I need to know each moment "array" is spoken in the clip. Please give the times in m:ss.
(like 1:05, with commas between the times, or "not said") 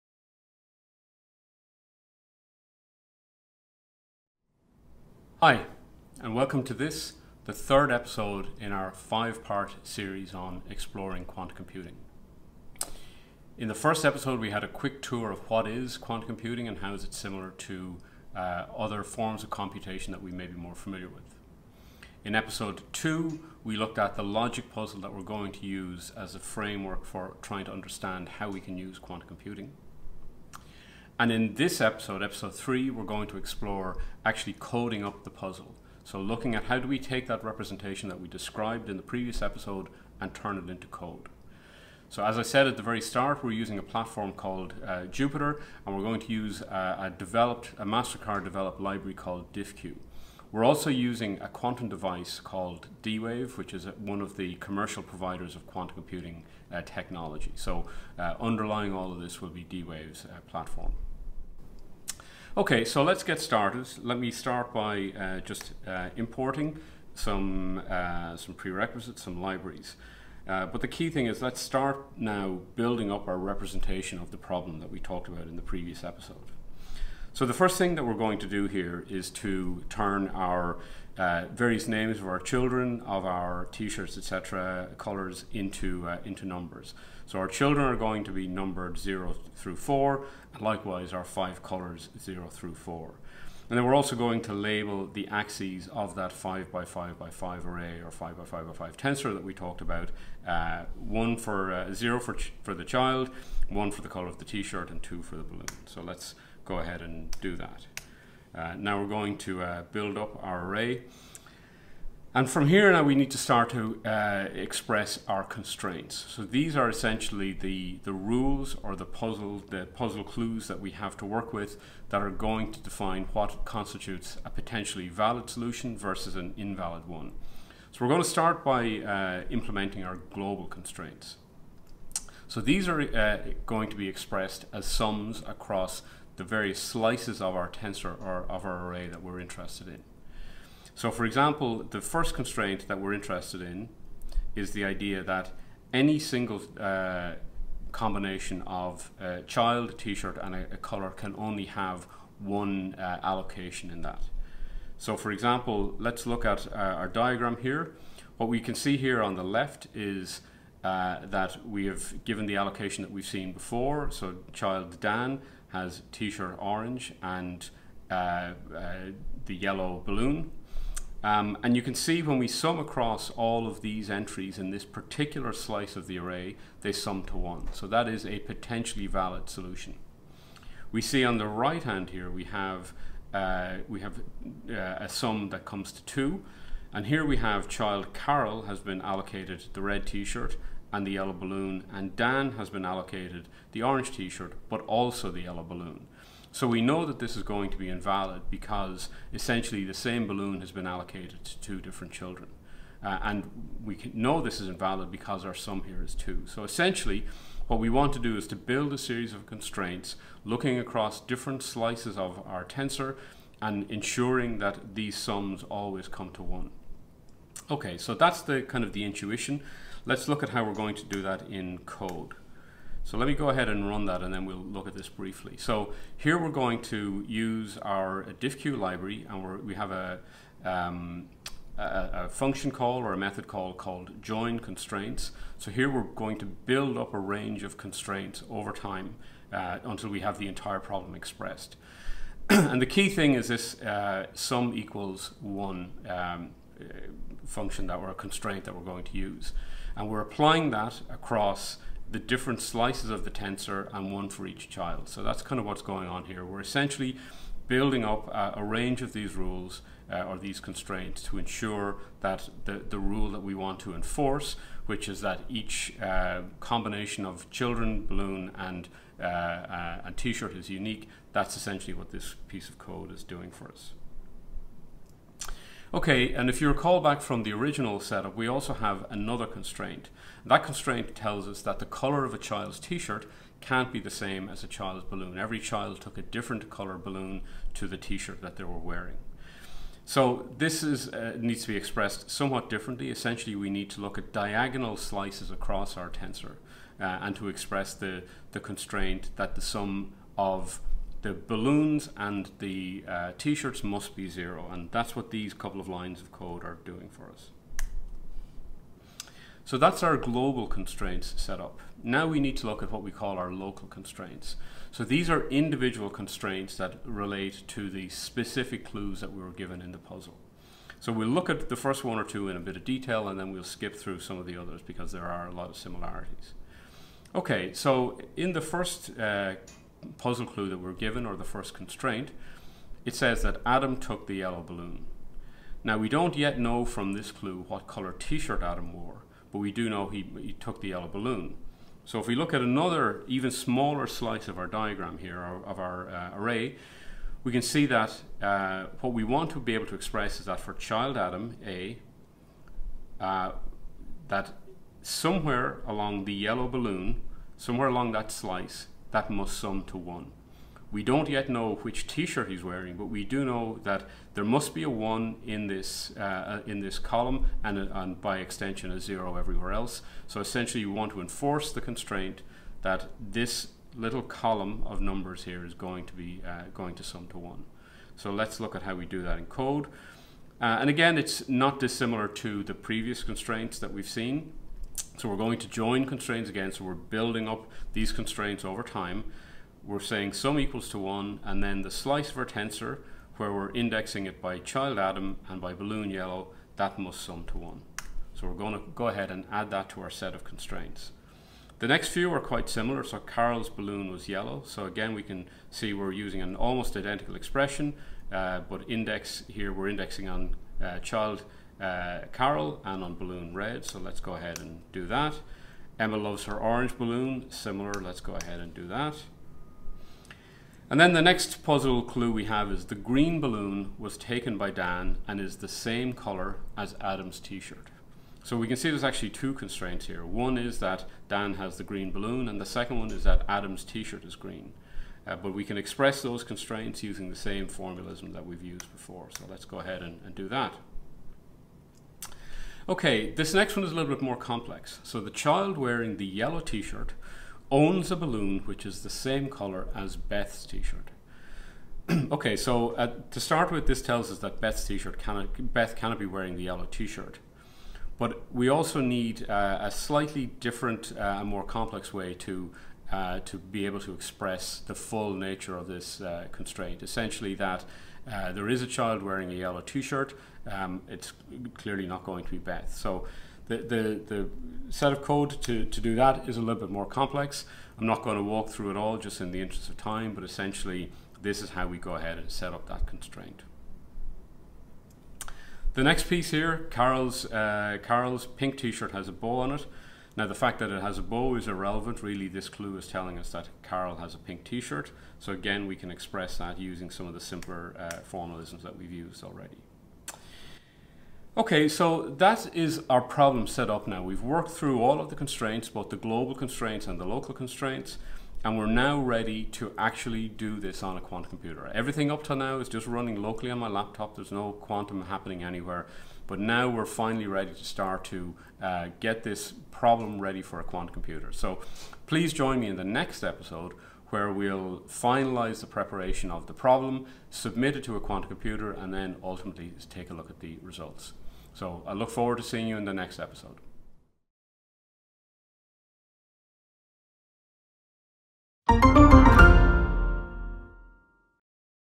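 1:37, 1:50, 2:18, 2:56, 5:46.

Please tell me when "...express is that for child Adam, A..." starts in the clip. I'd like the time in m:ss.
5:49.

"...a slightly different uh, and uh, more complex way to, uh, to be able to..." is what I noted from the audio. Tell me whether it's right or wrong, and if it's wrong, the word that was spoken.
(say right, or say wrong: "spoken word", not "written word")
right.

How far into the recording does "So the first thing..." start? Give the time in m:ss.
1:17.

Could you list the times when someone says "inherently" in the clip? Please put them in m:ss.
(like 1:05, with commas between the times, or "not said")
not said.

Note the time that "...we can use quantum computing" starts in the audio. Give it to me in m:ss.
0:28.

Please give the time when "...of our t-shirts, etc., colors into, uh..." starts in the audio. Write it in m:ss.
1:23.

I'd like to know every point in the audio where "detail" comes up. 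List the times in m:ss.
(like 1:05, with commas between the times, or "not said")
5:22.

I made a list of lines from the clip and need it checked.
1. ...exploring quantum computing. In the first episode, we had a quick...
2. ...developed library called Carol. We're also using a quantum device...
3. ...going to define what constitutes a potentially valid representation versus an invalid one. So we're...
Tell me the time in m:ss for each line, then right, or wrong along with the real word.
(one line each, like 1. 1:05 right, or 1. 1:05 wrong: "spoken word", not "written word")
1. 0:10 right
2. 0:48 wrong: "DiffQ", not "Carol"
3. 2:02 wrong: "solution", not "representation".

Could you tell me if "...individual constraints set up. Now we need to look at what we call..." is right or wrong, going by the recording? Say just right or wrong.
wrong.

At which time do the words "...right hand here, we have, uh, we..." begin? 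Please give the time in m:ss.
3:01.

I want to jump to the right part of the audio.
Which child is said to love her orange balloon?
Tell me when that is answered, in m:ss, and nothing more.
6:55.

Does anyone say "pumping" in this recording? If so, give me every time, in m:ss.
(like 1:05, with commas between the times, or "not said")
not said.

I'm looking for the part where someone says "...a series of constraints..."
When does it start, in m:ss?
3:28.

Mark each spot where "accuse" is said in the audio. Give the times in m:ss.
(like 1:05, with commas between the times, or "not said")
not said.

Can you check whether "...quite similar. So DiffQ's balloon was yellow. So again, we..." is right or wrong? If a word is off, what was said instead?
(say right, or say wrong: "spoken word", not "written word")
wrong: "Carol", not "DiffQ".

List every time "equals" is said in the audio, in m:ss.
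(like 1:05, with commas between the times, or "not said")
4:04, 6:30.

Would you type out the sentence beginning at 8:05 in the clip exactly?
The next piece here, Carol's, uh, Carol's pink t-shirt has a bow on it.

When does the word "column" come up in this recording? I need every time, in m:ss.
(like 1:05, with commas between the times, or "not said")
6:06, 6:14.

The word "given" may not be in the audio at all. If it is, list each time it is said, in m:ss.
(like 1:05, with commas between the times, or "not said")
2:42, 5:19, 5:30.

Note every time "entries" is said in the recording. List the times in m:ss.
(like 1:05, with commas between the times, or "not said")
2:54.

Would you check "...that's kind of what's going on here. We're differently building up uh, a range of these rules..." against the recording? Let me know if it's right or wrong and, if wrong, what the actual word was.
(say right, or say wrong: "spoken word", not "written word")
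wrong: "essentially", not "differently".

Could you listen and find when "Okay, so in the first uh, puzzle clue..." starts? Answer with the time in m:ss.
5:27.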